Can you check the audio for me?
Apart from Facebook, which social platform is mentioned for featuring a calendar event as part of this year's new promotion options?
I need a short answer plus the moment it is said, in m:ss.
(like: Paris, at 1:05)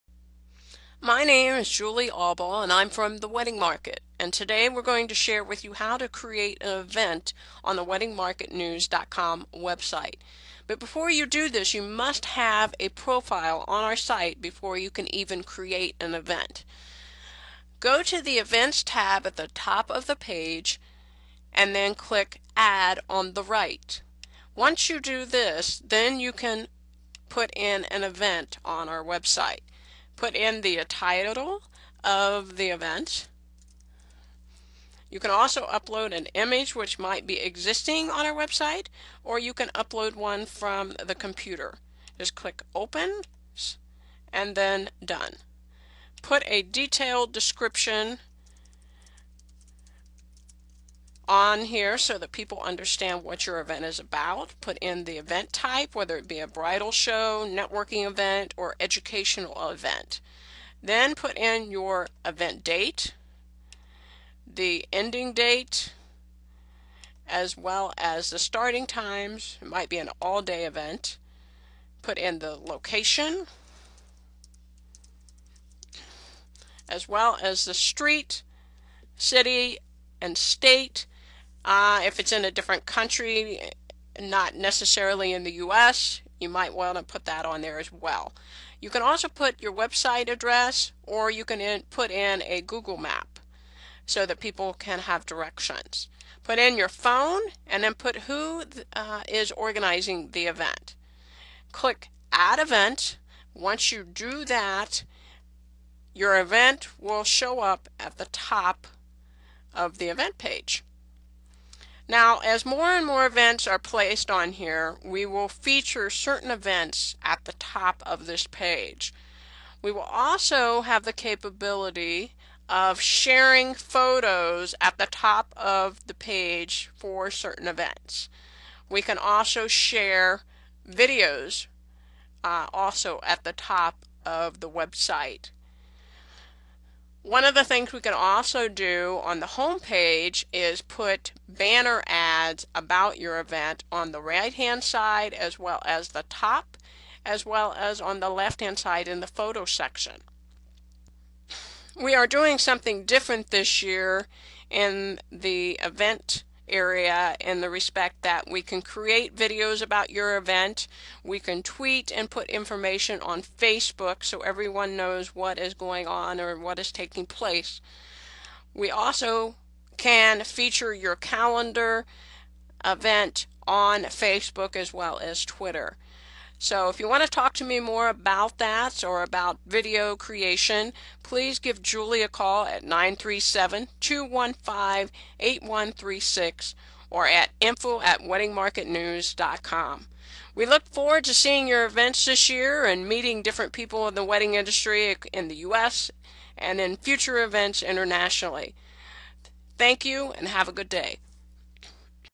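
Twitter, at 2:55.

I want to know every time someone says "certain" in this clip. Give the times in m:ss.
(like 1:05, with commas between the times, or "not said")
1:56, 2:07.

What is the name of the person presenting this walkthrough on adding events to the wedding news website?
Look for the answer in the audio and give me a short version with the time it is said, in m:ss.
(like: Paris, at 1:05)
Julie Aubel, at 0:01.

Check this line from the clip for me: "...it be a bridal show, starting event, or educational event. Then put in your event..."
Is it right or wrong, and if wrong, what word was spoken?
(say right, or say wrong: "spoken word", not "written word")
wrong: "networking", not "starting".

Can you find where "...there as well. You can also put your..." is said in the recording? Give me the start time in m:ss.
1:27.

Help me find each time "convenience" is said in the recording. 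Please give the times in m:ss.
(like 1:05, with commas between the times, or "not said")
not said.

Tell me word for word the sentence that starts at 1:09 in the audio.
It might be an all-day event.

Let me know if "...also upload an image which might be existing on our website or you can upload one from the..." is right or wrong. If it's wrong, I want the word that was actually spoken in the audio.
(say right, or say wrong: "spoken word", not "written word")
right.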